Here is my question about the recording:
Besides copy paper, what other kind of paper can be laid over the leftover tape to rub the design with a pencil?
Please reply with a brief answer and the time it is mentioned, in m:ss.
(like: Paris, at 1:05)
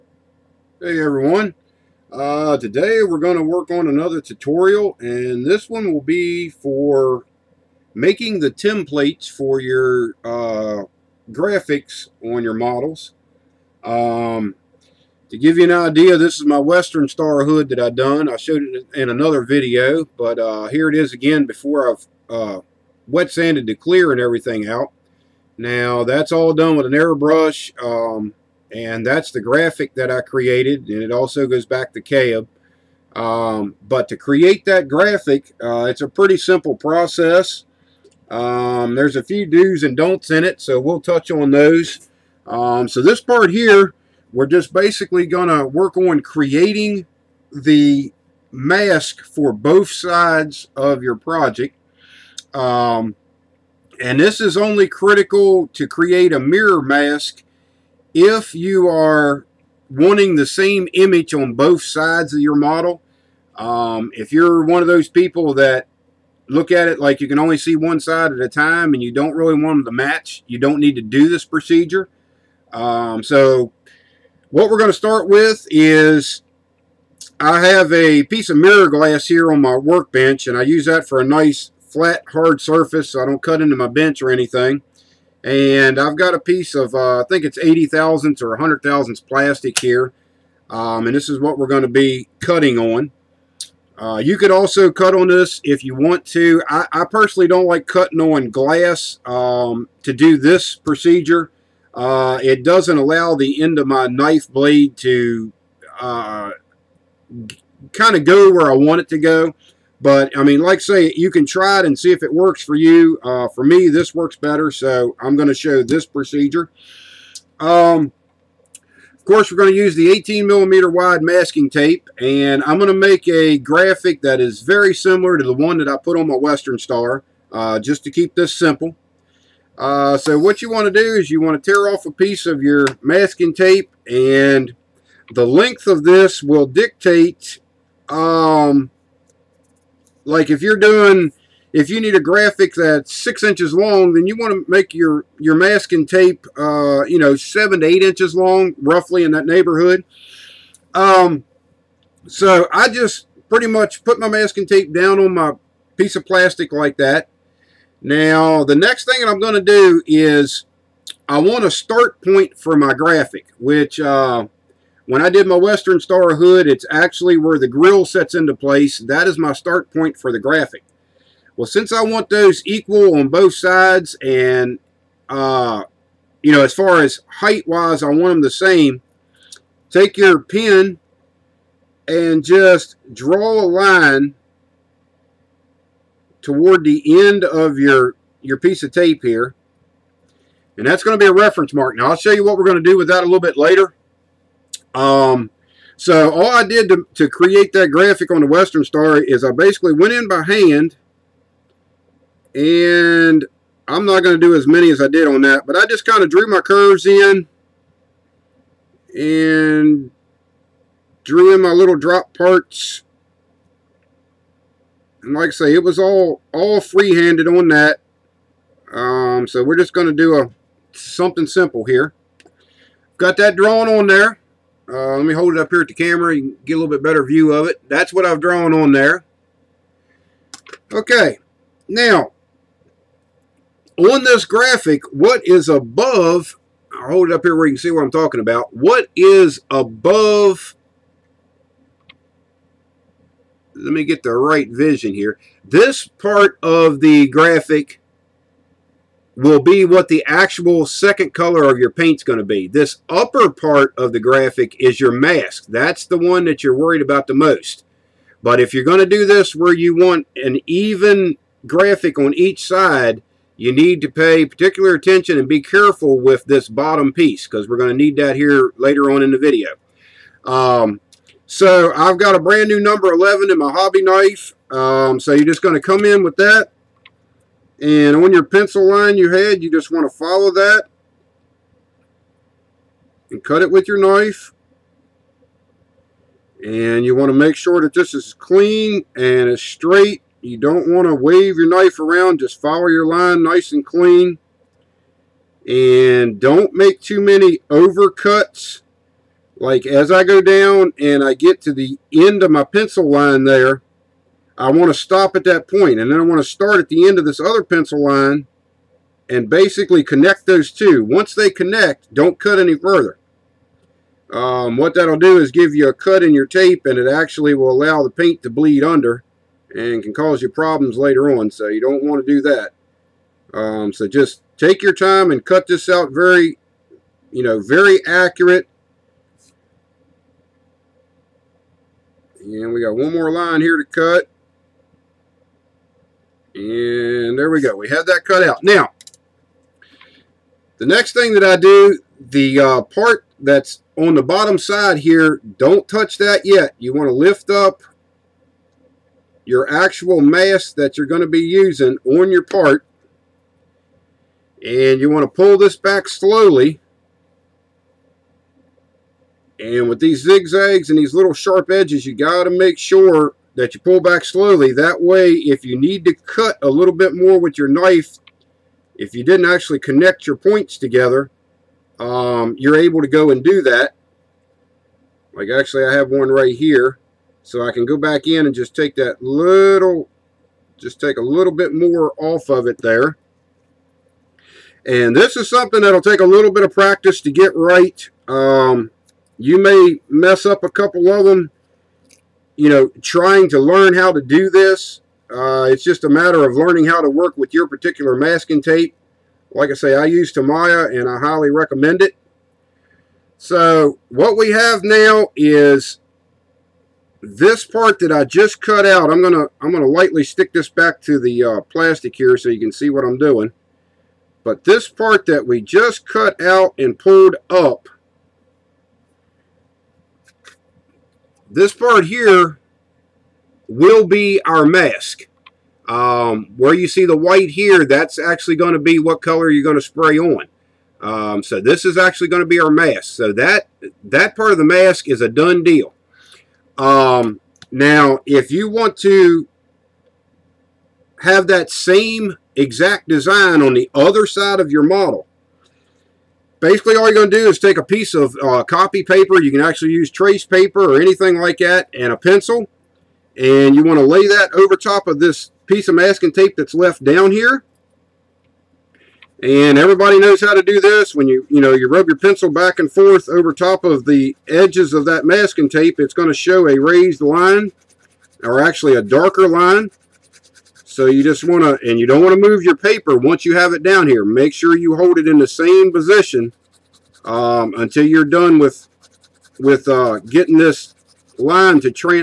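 trace paper, at 7:30.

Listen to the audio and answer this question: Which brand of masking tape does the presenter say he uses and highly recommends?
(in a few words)
Tamiya.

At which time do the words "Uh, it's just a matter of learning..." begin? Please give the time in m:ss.
6:35.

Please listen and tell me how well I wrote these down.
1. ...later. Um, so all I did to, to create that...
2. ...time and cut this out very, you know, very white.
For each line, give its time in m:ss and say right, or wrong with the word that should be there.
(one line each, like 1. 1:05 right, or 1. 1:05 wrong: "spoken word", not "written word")
1. 3:13 right
2. 5:24 wrong: "accurate", not "white".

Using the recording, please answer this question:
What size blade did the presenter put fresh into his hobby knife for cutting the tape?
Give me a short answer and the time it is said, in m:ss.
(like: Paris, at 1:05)
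number 11, at 4:32.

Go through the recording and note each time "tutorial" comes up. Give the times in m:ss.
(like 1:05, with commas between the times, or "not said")
0:04.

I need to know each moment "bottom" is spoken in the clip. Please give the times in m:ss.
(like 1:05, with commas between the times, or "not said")
4:26, 5:44.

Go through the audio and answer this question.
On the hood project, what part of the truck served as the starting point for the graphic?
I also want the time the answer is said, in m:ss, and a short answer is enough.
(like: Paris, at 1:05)
the grill, at 2:47.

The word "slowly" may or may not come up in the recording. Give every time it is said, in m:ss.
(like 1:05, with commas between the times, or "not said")
5:56, 6:04.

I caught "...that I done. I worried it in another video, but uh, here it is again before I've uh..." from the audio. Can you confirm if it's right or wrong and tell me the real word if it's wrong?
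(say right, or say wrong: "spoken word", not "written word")
wrong: "showed", not "worried".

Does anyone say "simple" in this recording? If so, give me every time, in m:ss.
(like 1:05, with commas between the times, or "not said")
0:36, 2:08, 3:41.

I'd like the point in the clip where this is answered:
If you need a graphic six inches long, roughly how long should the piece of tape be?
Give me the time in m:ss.
2:27.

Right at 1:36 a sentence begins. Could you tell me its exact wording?
I, I personally don't like cutting on glass um, to do this procedure.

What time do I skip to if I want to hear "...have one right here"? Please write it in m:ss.
6:15.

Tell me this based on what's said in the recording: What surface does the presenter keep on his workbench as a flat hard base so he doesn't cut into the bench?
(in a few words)
mirror glass.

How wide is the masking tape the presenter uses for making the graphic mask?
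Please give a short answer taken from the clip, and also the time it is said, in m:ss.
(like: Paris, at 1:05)
18 millimeter, at 2:00.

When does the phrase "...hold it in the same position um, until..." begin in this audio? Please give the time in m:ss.
7:54.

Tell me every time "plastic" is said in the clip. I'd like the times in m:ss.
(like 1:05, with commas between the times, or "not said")
1:29, 2:36, 6:51.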